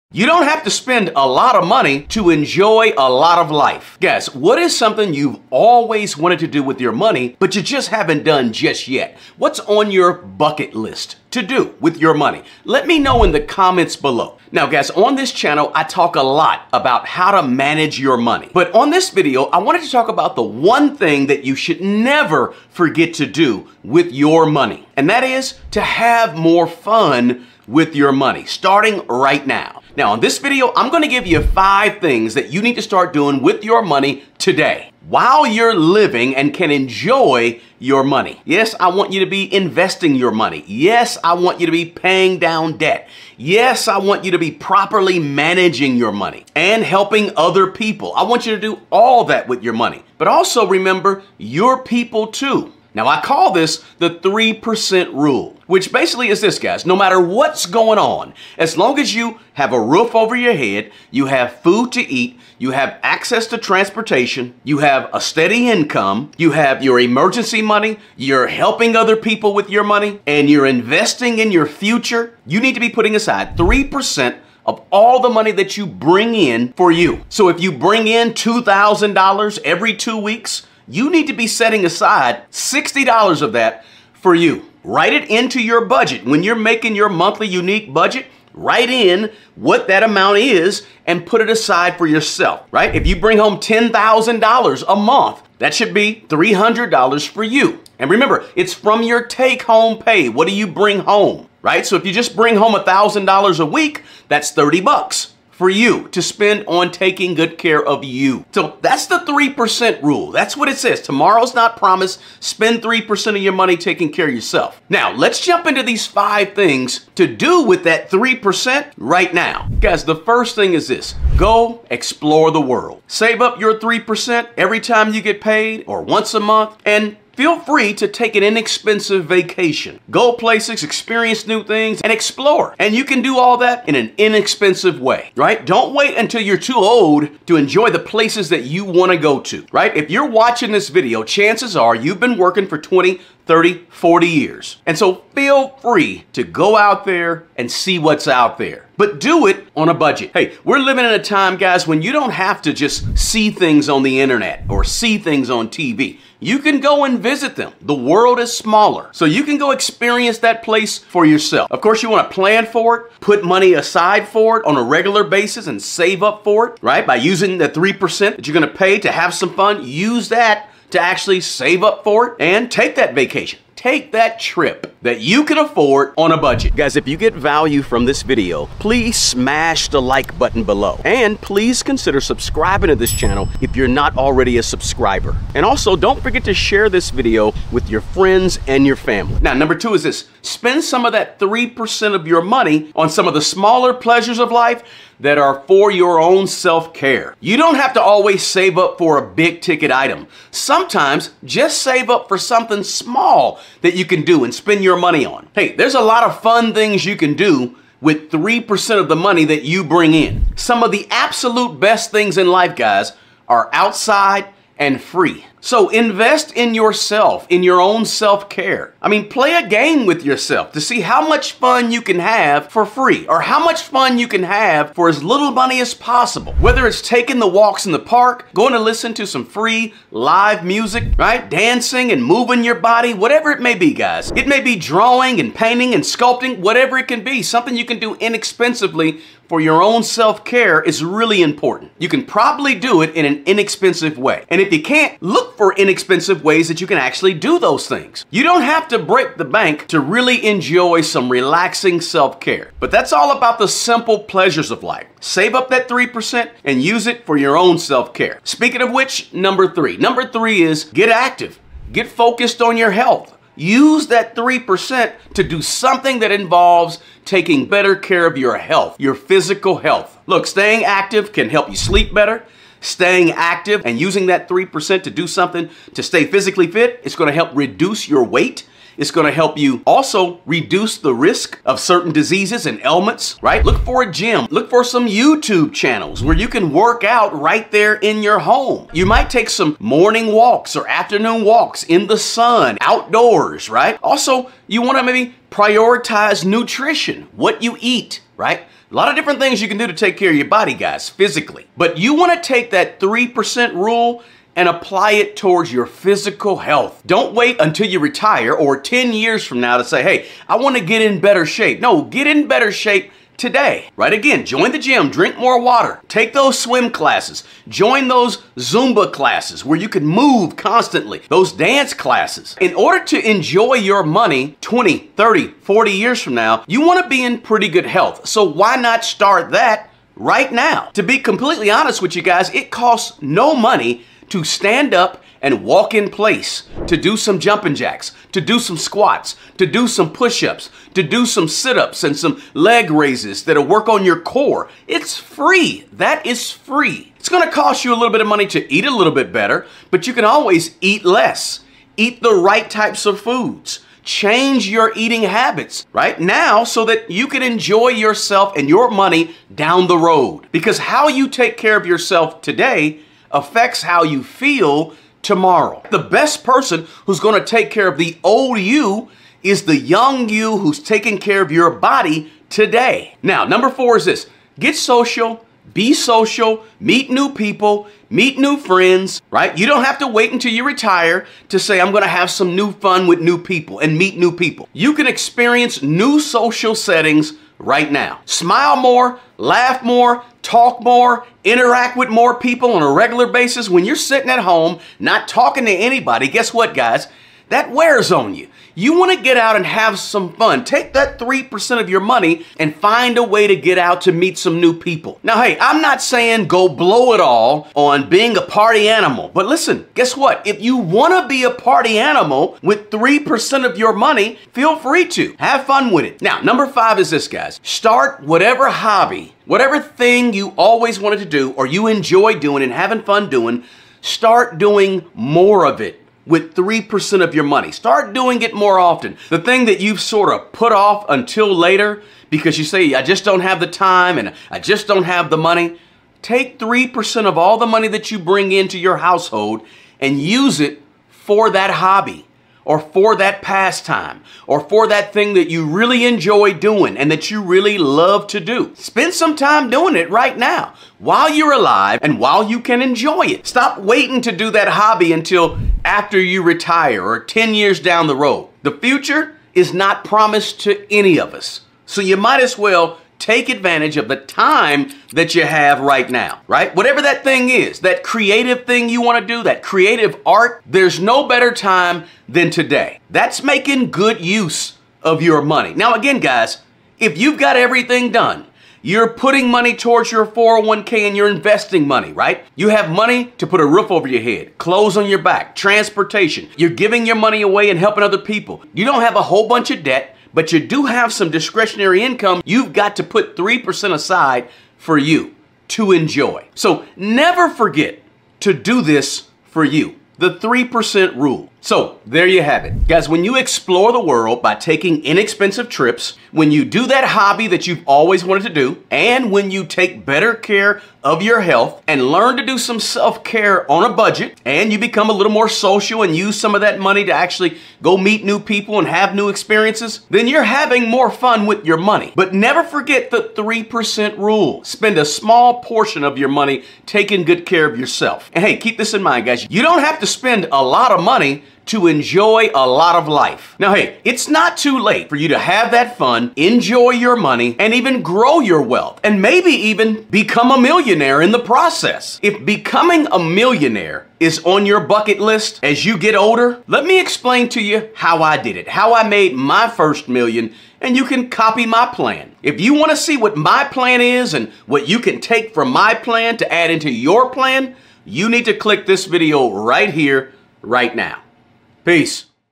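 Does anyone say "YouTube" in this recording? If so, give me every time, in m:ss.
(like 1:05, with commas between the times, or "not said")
4:45.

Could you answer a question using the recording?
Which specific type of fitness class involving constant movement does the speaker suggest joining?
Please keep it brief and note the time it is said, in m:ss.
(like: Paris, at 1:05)
Zumba, at 5:18.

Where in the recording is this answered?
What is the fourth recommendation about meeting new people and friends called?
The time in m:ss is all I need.
6:14.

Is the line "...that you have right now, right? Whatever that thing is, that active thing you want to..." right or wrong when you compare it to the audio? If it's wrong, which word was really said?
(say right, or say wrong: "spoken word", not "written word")
wrong: "creative", not "active".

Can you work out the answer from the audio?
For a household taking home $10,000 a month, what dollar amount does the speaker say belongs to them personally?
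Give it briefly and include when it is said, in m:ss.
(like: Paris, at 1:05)
$300, at 1:36.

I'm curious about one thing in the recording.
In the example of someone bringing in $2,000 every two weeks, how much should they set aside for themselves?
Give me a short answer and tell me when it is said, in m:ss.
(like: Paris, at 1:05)
$60, at 1:22.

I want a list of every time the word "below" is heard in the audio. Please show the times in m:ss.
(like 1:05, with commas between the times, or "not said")
0:13, 3:00.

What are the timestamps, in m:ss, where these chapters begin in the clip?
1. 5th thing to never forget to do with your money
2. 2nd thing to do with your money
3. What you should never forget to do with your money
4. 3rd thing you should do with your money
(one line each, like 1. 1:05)
1. 6:56
2. 3:09
3. 0:25
4. 4:19.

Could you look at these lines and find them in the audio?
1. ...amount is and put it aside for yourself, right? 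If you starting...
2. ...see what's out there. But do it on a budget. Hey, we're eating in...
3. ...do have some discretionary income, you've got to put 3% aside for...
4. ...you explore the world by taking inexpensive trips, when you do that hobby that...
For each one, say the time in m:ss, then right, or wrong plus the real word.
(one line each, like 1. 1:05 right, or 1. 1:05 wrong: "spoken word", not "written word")
1. 1:30 wrong: "bring", not "starting"
2. 2:27 wrong: "living", not "eating"
3. 8:10 right
4. 8:23 right.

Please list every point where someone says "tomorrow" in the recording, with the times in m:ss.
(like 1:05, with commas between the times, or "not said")
1:51, 6:05.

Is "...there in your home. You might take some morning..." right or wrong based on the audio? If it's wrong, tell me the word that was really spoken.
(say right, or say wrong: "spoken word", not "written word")
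right.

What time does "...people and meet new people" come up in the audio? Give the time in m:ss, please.
6:23.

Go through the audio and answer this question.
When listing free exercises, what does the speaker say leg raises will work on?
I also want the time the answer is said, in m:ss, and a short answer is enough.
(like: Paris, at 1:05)
Your core, at 5:44.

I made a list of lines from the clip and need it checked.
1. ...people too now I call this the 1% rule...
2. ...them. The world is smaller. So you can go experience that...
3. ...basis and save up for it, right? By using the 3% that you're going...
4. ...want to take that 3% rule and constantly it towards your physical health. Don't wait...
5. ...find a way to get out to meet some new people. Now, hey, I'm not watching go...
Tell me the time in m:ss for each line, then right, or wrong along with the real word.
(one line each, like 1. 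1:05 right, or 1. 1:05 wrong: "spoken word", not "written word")
1. 0:51 wrong: "3", not "1"
2. 2:37 right
3. 2:45 right
4. 5:02 wrong: "apply", not "constantly"
5. 6:42 wrong: "saying", not "watching".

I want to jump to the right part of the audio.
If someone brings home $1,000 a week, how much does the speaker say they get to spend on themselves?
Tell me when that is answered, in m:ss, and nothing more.
1:44.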